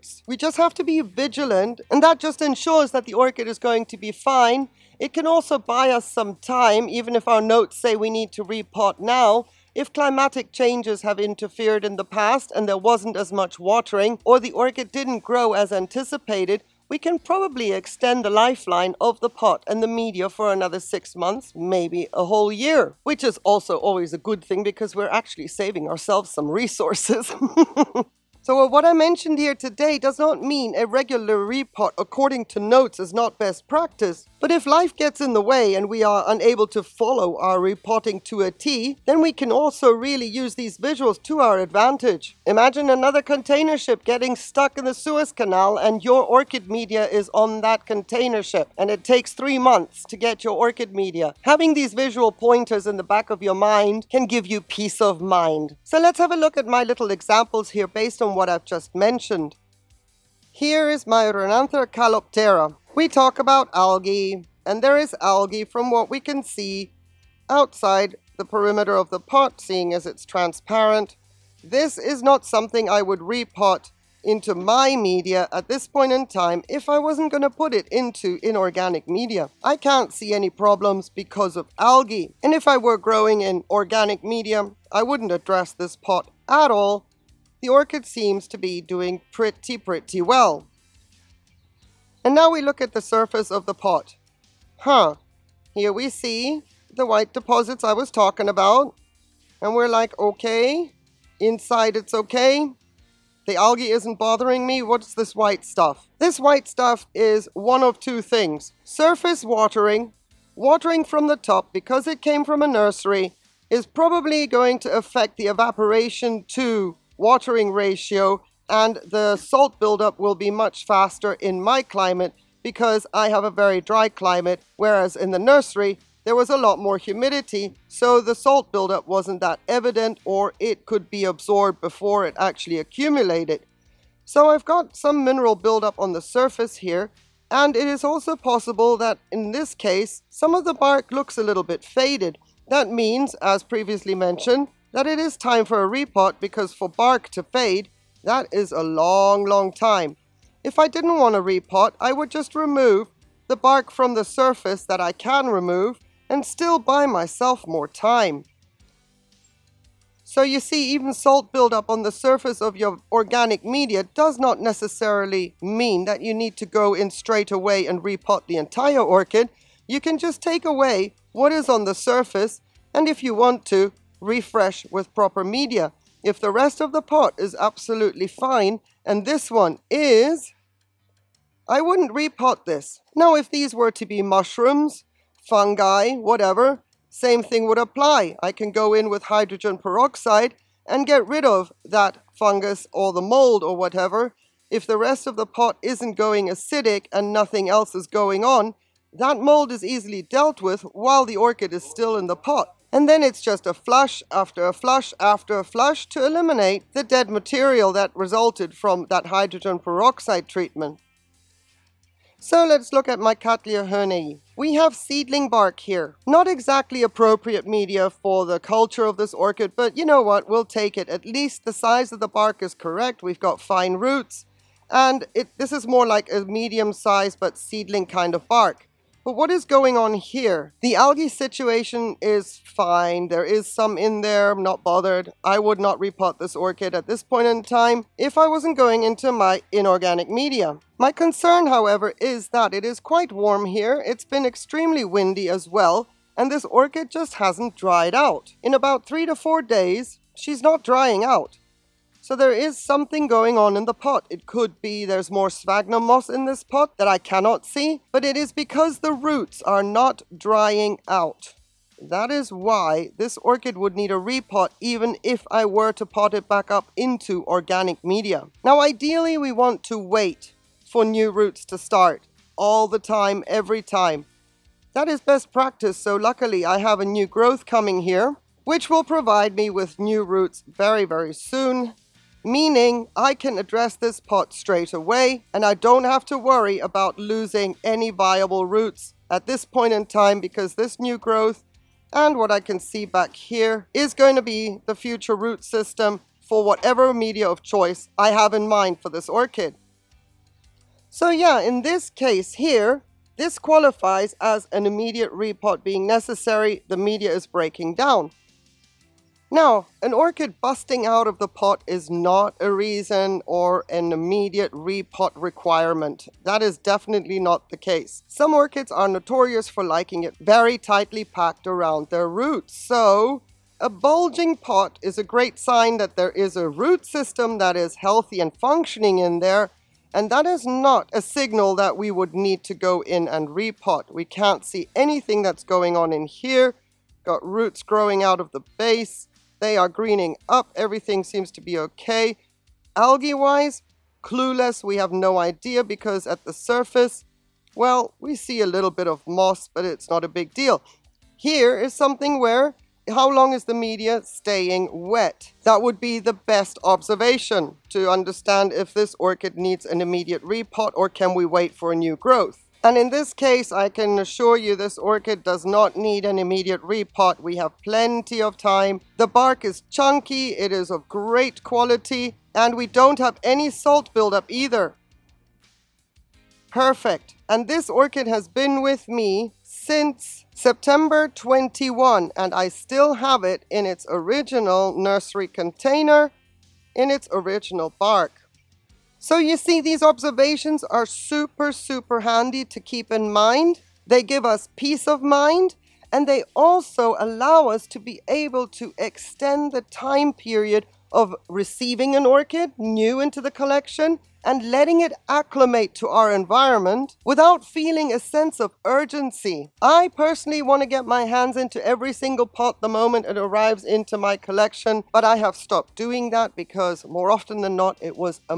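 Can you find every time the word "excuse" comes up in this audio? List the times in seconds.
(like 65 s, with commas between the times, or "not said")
not said.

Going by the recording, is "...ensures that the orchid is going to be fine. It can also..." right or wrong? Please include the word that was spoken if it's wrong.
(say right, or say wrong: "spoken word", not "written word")
right.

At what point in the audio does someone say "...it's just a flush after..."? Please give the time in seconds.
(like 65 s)
203 s.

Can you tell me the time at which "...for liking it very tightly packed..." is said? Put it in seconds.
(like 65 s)
319 s.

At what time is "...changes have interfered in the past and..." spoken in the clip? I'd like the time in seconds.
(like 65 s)
10 s.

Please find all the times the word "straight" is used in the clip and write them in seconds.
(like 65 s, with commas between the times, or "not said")
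167 s, 284 s.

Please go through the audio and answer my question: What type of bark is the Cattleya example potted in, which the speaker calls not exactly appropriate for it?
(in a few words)
seedling bark.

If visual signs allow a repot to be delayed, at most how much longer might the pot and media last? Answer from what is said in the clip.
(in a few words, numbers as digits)
a whole year.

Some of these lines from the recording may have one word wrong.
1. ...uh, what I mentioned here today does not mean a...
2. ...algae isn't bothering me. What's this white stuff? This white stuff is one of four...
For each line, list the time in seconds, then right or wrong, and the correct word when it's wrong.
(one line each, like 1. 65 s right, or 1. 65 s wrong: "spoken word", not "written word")
1. 28 s right
2. 103 s wrong: "two", not "four".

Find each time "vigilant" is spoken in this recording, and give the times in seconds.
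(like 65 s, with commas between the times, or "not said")
1 s.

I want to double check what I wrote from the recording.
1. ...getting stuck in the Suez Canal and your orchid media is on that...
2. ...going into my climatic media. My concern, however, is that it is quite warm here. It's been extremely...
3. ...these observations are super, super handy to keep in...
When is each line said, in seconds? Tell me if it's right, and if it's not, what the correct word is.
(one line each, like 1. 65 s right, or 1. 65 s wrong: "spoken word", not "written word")
1. 44 s right
2. 238 s wrong: "inorganic", not "climatic"
3. 389 s right.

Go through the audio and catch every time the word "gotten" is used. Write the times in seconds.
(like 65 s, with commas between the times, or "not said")
not said.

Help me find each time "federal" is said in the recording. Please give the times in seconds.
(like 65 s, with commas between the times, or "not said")
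not said.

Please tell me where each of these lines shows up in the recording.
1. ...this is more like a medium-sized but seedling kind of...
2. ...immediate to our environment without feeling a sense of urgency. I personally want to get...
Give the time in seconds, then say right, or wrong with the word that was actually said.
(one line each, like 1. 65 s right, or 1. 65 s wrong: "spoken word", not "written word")
1. 225 s right
2. 405 s wrong: "acclimate", not "immediate".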